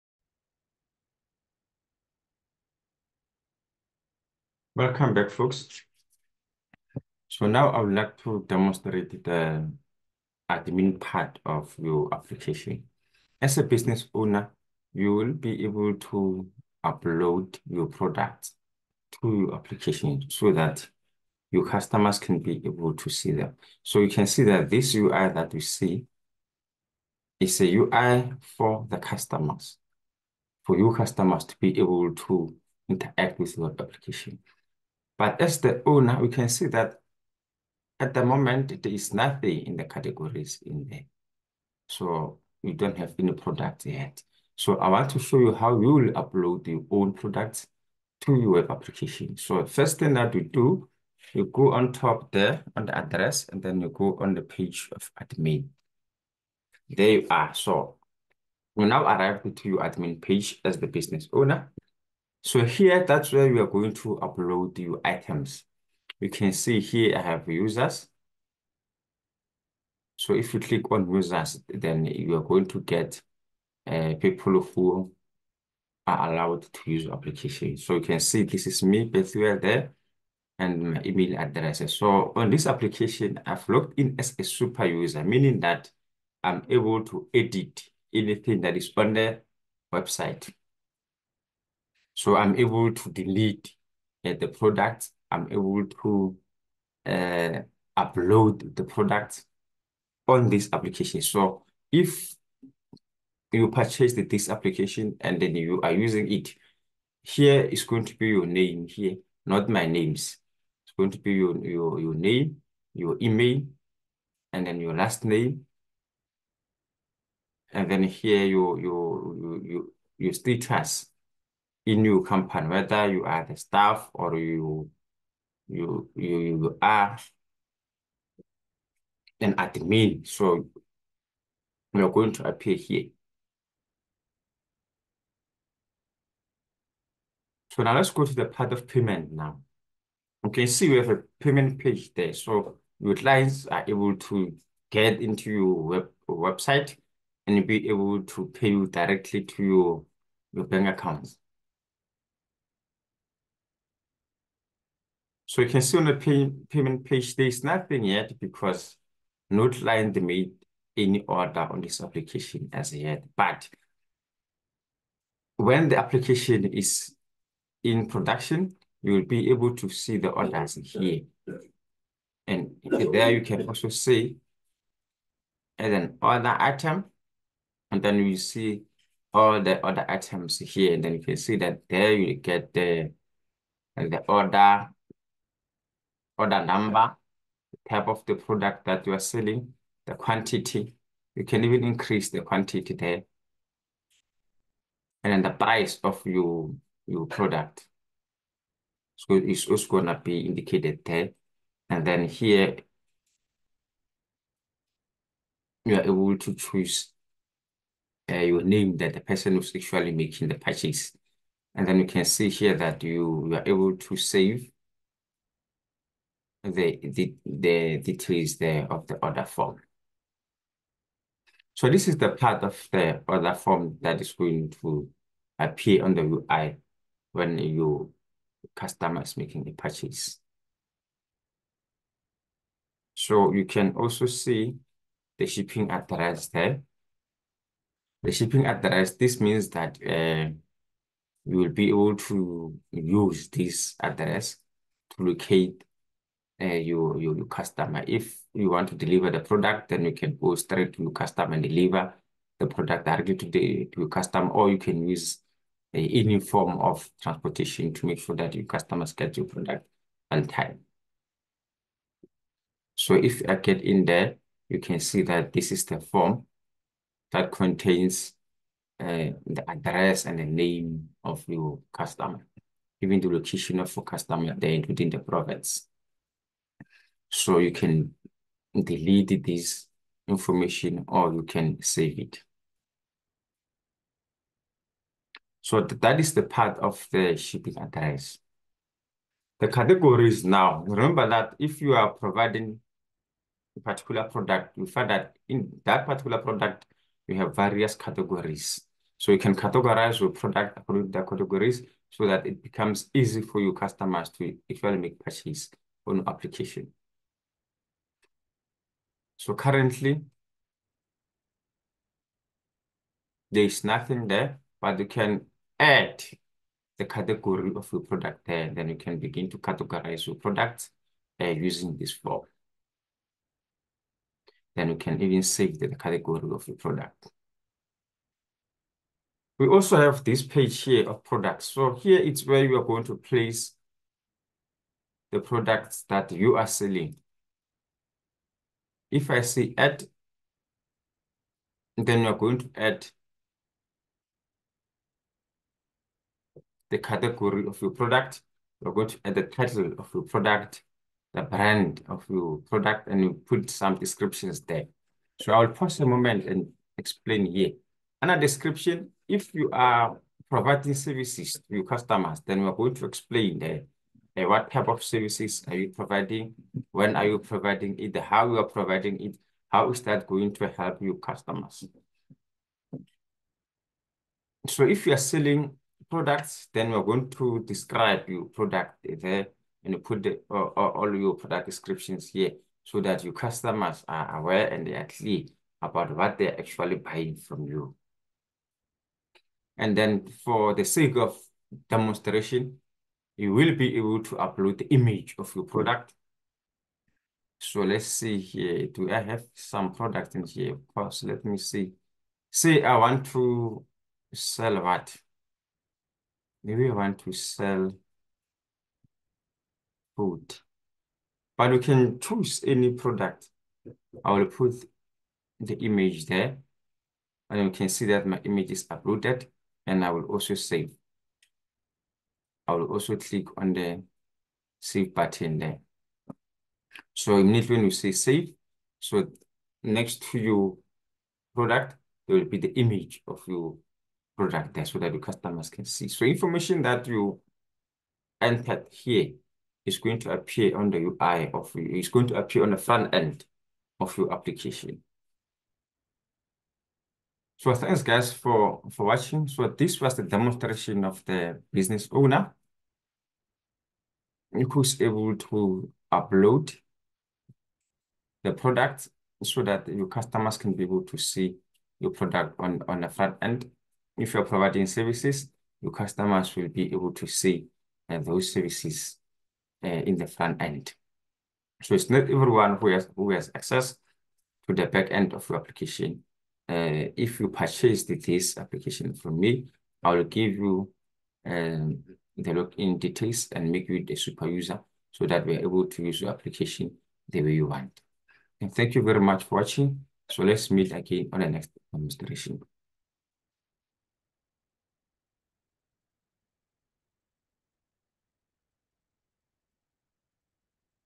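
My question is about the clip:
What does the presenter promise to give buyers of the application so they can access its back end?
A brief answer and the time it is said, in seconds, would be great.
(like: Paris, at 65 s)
login details, at 482 s.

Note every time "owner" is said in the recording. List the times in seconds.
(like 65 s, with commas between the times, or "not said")
14 s, 35 s, 61 s, 452 s.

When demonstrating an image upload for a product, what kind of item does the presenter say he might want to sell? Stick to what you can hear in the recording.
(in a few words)
food.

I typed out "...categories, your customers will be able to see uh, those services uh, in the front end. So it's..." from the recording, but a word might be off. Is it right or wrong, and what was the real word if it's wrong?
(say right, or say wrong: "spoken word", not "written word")
wrong: "services", not "categories".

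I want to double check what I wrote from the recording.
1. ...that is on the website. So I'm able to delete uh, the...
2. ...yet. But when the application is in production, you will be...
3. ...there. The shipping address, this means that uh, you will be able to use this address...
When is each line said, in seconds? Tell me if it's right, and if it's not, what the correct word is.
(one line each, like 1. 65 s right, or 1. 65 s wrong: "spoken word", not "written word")
1. 88 s right
2. 162 s right
3. 236 s right.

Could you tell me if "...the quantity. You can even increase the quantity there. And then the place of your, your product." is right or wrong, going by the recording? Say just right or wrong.
wrong.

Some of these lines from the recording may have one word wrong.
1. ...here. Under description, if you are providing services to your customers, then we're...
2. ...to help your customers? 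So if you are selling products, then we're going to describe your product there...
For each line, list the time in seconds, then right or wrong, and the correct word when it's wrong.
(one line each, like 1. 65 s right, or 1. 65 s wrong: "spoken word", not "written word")
1. 357 s right
2. 370 s right.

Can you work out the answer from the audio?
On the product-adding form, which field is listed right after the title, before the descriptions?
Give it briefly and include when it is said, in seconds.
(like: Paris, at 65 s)
brand, at 351 s.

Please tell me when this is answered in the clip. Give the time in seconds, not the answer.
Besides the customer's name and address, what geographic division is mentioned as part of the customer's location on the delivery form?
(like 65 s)
275 s.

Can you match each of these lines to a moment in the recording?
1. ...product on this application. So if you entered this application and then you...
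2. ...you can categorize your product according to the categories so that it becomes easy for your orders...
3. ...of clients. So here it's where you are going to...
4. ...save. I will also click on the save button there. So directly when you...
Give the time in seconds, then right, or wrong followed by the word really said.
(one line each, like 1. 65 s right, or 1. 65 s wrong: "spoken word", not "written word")
1. 98 s wrong: "purchased", not "entered"
2. 299 s wrong: "customers", not "orders"
3. 331 s wrong: "products", not "clients"
4. 420 s wrong: "immediately", not "directly".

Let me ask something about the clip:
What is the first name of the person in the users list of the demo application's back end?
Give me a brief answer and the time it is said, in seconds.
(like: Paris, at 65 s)
Bethuel, at 79 s.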